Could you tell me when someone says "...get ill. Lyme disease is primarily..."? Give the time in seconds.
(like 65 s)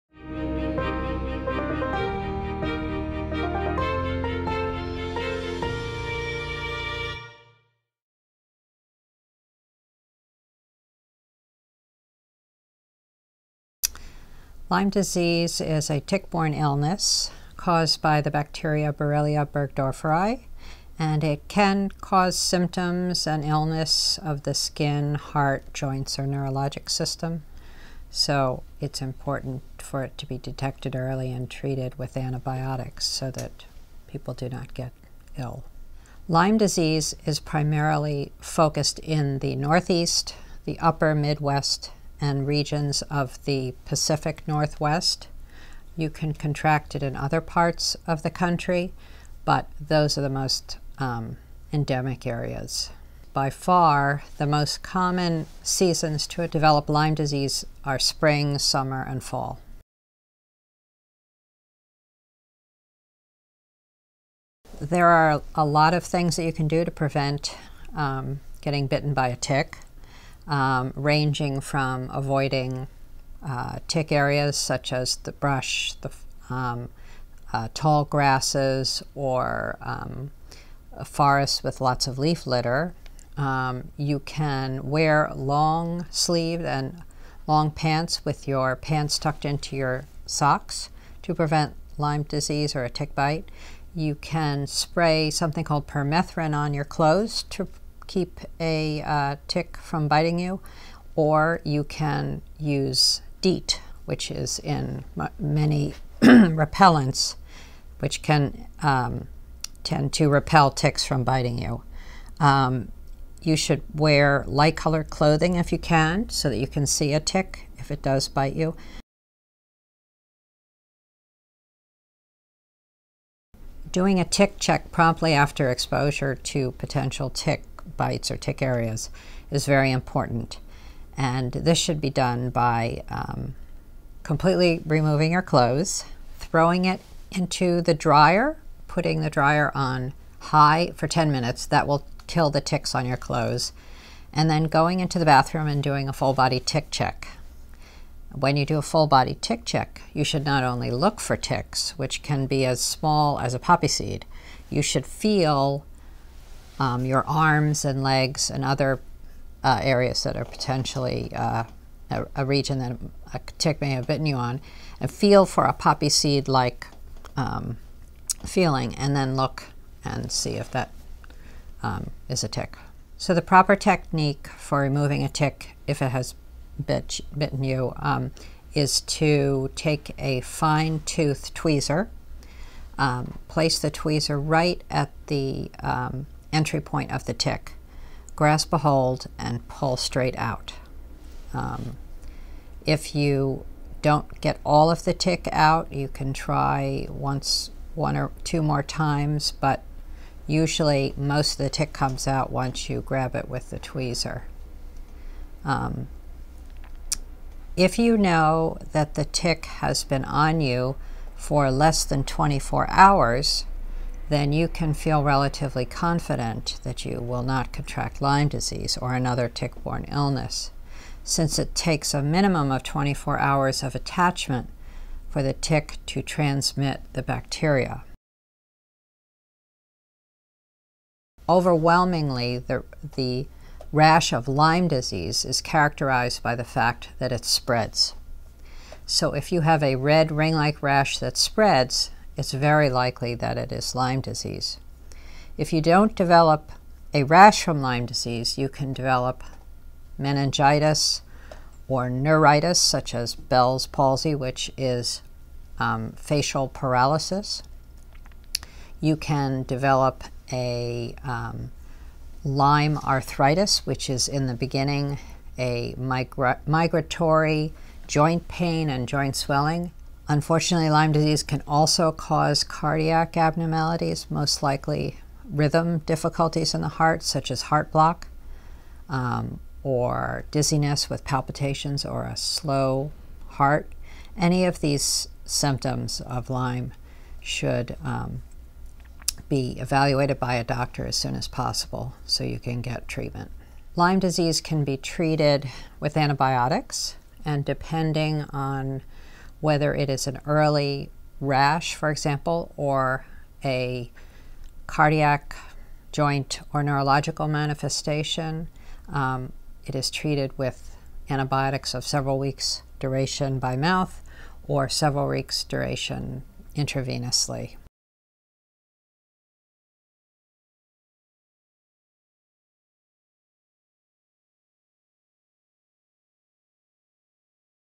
34 s.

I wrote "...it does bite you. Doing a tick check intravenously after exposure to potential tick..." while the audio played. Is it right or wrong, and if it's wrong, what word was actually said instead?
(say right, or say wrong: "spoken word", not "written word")
wrong: "promptly", not "intravenously".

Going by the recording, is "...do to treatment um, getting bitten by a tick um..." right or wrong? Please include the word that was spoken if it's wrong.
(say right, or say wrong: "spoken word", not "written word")
wrong: "prevent", not "treatment".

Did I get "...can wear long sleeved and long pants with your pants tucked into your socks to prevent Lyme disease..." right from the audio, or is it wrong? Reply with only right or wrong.
right.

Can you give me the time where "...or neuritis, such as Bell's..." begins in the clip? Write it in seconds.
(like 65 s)
251 s.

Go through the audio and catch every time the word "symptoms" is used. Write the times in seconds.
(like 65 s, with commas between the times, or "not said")
22 s, 285 s.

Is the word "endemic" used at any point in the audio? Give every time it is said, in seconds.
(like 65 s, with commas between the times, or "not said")
51 s.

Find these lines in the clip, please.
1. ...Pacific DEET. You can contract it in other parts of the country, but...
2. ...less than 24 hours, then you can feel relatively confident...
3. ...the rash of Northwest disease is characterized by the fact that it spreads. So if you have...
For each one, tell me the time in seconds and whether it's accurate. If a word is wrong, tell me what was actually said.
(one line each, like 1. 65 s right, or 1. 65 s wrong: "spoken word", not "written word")
1. 43 s wrong: "Northwest", not "DEET"
2. 211 s right
3. 233 s wrong: "Lyme", not "Northwest".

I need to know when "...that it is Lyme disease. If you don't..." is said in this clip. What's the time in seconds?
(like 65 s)
243 s.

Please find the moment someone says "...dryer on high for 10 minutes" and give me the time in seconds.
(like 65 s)
139 s.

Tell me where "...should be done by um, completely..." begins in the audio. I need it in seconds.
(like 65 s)
131 s.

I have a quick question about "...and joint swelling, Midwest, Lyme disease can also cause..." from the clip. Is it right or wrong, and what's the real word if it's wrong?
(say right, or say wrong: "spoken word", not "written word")
wrong: "Unfortunately", not "Midwest".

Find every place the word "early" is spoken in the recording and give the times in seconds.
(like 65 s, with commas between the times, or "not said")
30 s, 300 s.